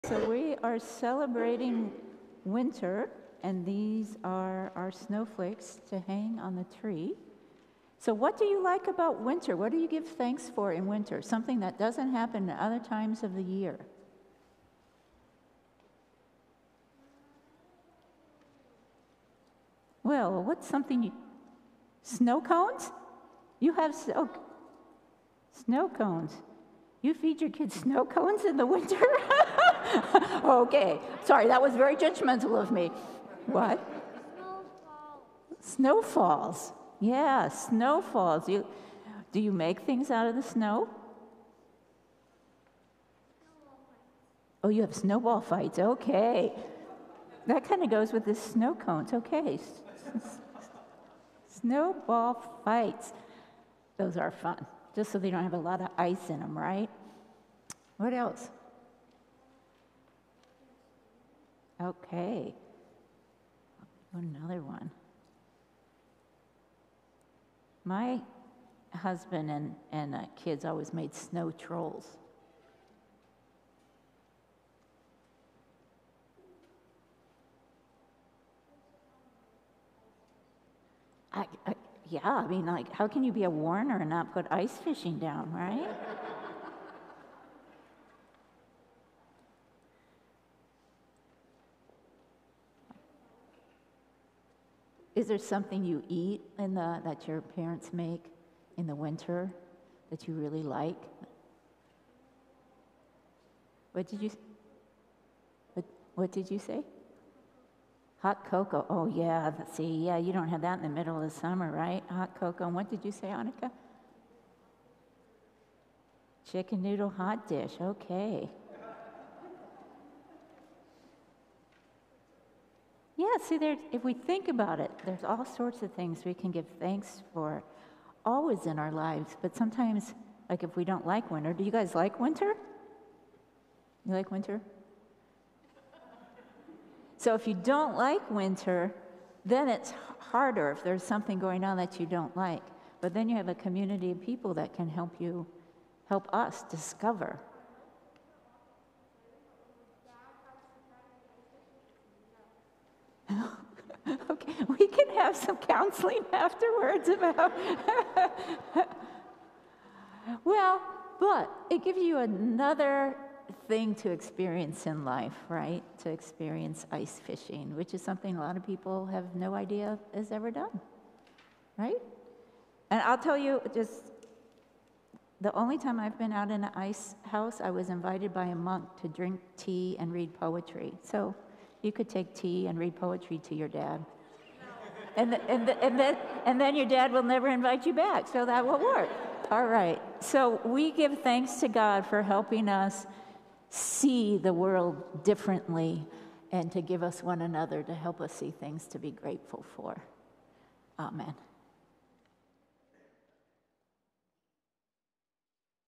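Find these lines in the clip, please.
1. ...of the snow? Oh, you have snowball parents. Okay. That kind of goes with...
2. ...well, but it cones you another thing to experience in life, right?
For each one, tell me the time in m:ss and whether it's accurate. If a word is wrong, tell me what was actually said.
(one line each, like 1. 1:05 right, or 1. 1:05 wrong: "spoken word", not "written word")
1. 0:40 wrong: "fights", not "parents"
2. 2:40 wrong: "gives", not "cones".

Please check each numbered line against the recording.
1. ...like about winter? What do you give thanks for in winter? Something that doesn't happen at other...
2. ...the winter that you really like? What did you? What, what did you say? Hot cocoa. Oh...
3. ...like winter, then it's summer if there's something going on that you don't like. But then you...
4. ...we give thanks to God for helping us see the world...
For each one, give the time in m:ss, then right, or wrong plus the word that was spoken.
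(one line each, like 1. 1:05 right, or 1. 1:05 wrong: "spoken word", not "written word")
1. 0:08 right
2. 1:38 right
3. 2:17 wrong: "harder", not "summer"
4. 3:10 right.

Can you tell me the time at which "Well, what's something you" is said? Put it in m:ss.
0:20.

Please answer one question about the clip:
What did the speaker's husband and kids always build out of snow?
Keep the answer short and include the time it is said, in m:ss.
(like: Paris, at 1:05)
Snow trolls, at 1:11.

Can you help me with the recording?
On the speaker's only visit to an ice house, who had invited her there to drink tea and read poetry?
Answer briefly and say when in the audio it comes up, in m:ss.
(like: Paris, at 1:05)
A monk, at 2:58.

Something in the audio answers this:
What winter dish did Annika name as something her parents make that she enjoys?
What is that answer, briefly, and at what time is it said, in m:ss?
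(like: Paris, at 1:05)
Chicken noodle hot dish, at 1:56.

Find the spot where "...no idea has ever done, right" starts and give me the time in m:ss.
2:49.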